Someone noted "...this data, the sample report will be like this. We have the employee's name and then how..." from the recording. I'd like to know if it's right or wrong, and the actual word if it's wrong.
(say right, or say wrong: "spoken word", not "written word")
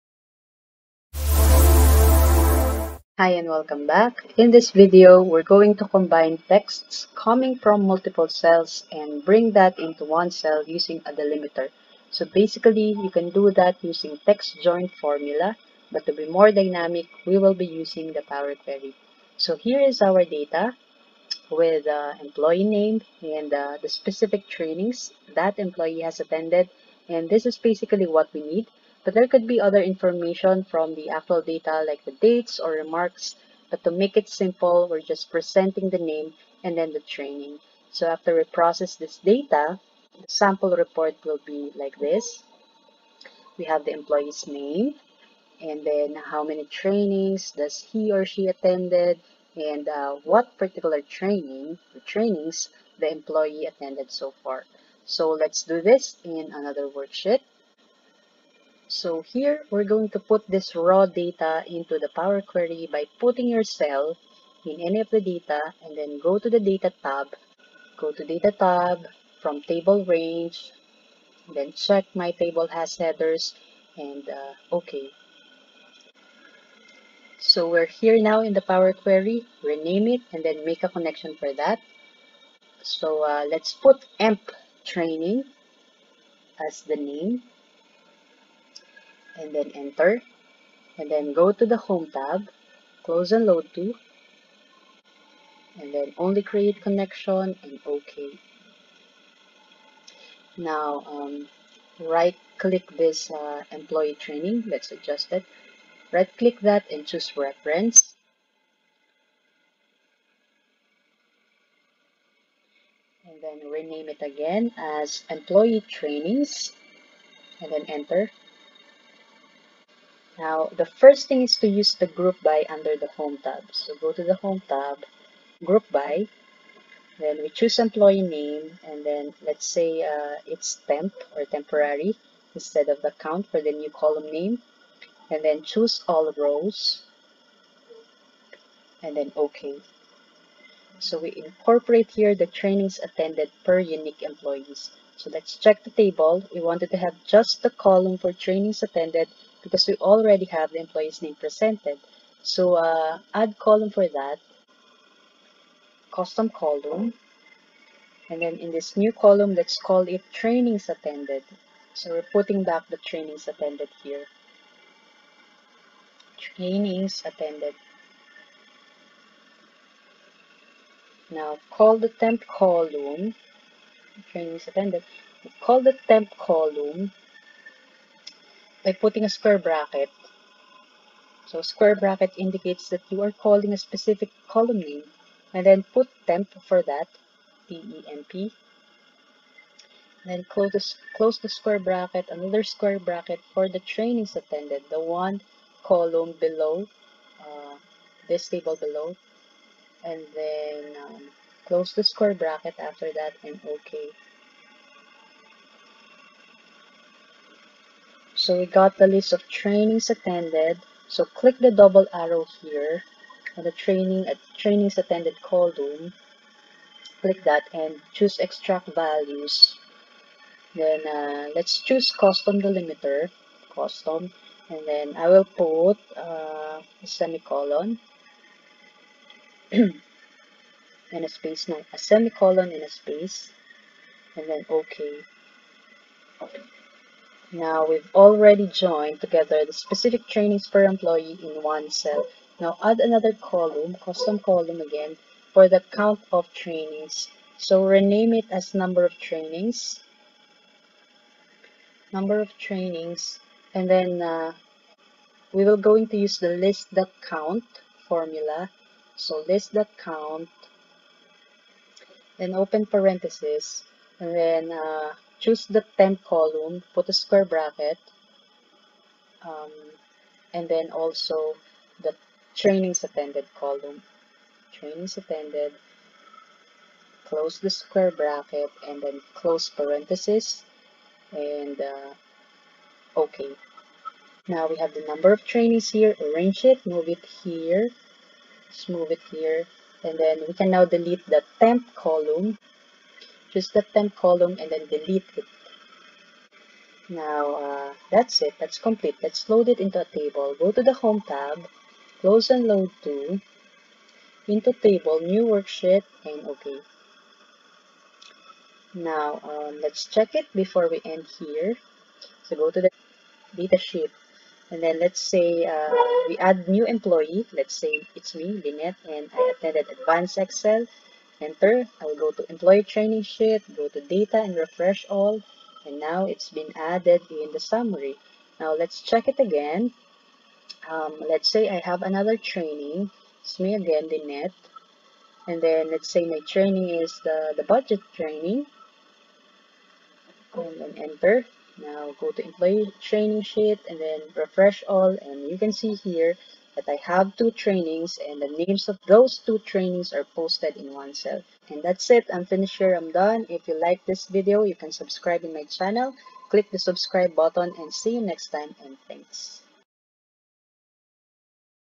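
right.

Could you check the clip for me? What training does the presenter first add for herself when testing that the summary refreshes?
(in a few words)
Advanced Excel.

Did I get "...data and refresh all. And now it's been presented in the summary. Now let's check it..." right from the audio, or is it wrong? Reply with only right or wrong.
wrong.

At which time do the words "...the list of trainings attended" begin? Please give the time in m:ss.
3:28.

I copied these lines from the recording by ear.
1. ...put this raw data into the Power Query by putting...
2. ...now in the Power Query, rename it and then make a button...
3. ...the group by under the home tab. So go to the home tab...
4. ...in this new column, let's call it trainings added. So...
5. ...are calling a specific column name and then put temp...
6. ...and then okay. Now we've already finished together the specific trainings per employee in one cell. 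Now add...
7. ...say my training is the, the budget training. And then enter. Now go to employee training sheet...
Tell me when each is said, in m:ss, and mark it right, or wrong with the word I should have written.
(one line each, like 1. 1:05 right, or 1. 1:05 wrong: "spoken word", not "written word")
1. 1:00 right
2. 1:18 wrong: "connection", not "button"
3. 2:01 right
4. 2:38 wrong: "attended", not "added"
5. 3:03 right
6. 3:54 wrong: "joined", not "finished"
7. 5:36 right.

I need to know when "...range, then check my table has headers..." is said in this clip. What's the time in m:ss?
1:10.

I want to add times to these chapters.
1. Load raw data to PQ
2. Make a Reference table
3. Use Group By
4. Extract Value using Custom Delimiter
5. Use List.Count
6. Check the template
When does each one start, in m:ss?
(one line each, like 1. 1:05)
1. 0:56
2. 1:37
3. 1:57
4. 3:28
5. 3:59
6. 5:07.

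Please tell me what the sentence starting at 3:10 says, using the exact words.
Then close the, close the square bracket, another square bracket for the trainings attended, the one column below, uh, this table below.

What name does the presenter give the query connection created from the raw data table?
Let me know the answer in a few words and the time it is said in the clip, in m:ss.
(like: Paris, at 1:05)
emp training, at 1:24.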